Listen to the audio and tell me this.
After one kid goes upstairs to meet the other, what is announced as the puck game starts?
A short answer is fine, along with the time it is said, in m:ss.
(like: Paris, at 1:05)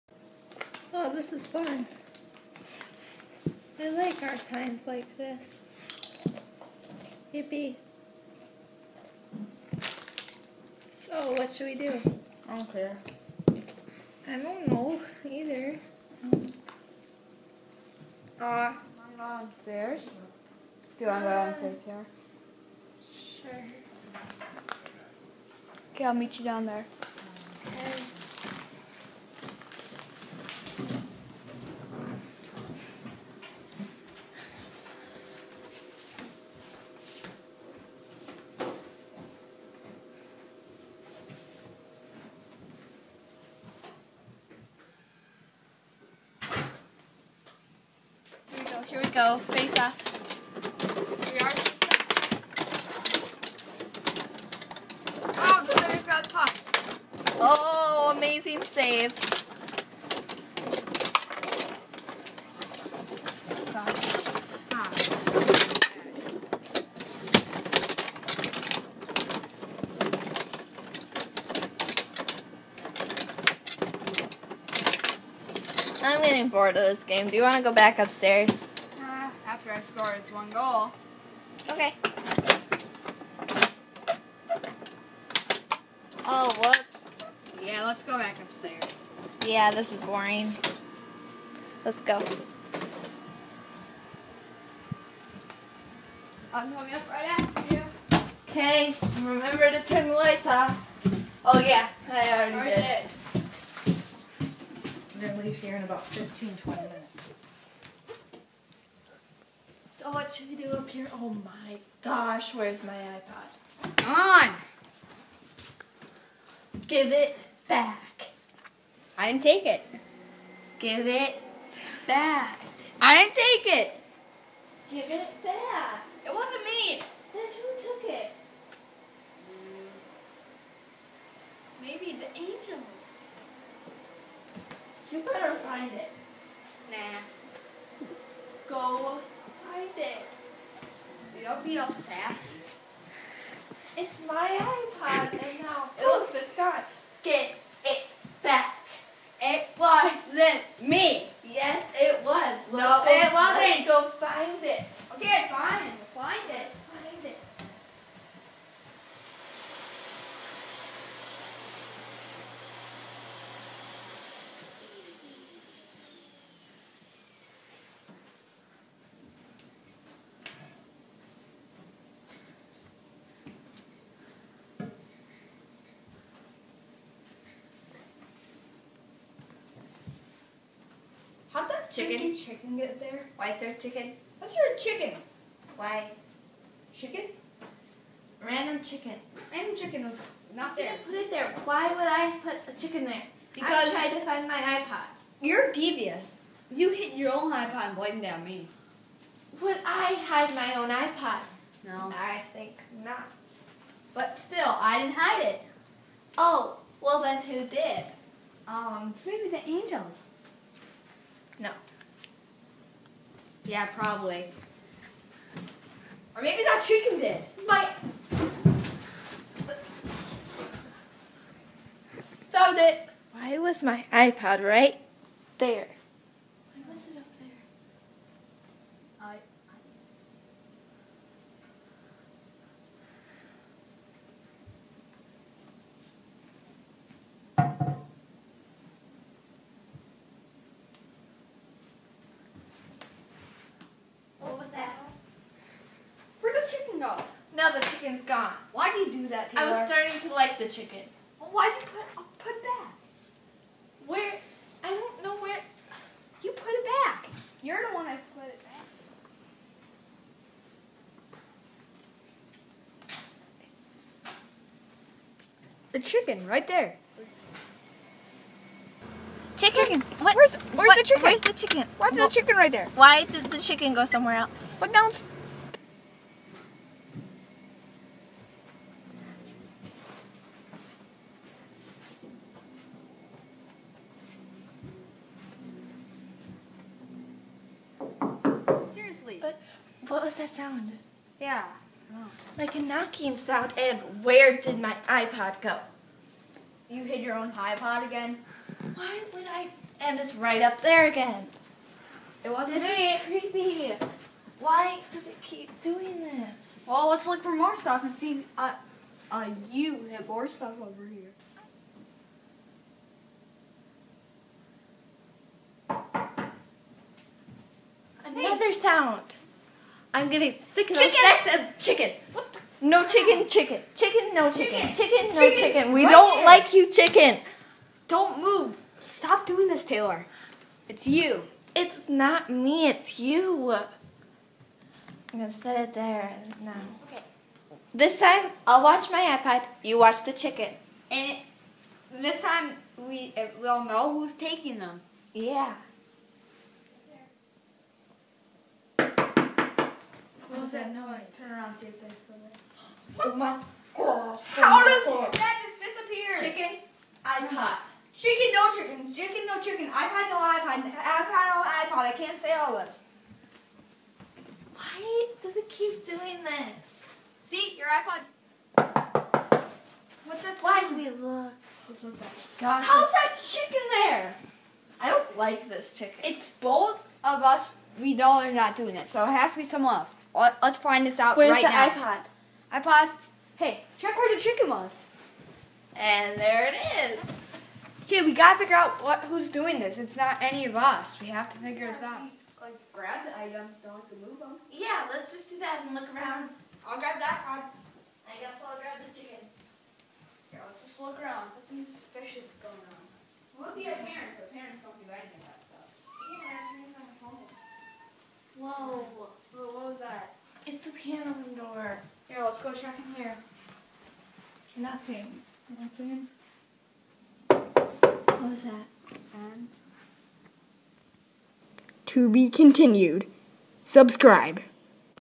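Face off, at 0:49.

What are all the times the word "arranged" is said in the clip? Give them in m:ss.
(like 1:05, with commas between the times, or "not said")
not said.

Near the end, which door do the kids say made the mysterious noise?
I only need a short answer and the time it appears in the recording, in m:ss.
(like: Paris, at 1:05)
Piano door, at 6:50.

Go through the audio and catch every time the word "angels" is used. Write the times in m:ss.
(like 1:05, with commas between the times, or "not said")
2:12, 3:29.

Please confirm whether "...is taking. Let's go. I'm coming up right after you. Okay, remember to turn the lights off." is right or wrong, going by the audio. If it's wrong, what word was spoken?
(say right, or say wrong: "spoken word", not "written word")
wrong: "boring", not "taking".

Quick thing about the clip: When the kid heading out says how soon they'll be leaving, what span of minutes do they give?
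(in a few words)
15, 20 minutes.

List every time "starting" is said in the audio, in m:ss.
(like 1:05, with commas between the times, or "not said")
4:09.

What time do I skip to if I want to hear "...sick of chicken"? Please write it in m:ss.
5:20.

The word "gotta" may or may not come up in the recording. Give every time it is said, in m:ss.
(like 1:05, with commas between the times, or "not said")
6:28.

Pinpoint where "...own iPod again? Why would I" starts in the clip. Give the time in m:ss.
4:57.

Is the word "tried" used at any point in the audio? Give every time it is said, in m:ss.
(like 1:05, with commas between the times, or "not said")
3:14.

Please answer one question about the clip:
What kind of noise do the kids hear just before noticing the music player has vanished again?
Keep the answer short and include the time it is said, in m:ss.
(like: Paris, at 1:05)
A knocking sound, at 4:52.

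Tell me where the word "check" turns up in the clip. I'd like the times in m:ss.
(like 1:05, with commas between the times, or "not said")
6:23, 6:52.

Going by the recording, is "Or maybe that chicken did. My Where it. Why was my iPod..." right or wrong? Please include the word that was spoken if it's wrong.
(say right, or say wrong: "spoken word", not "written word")
wrong: "Found", not "Where".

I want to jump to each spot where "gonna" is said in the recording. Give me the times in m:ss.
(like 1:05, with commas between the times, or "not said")
1:45, 5:35.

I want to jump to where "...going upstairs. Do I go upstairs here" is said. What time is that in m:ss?
0:19.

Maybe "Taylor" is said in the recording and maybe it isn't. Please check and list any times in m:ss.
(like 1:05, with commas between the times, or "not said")
4:09, 5:29.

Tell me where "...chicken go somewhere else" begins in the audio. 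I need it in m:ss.
4:33.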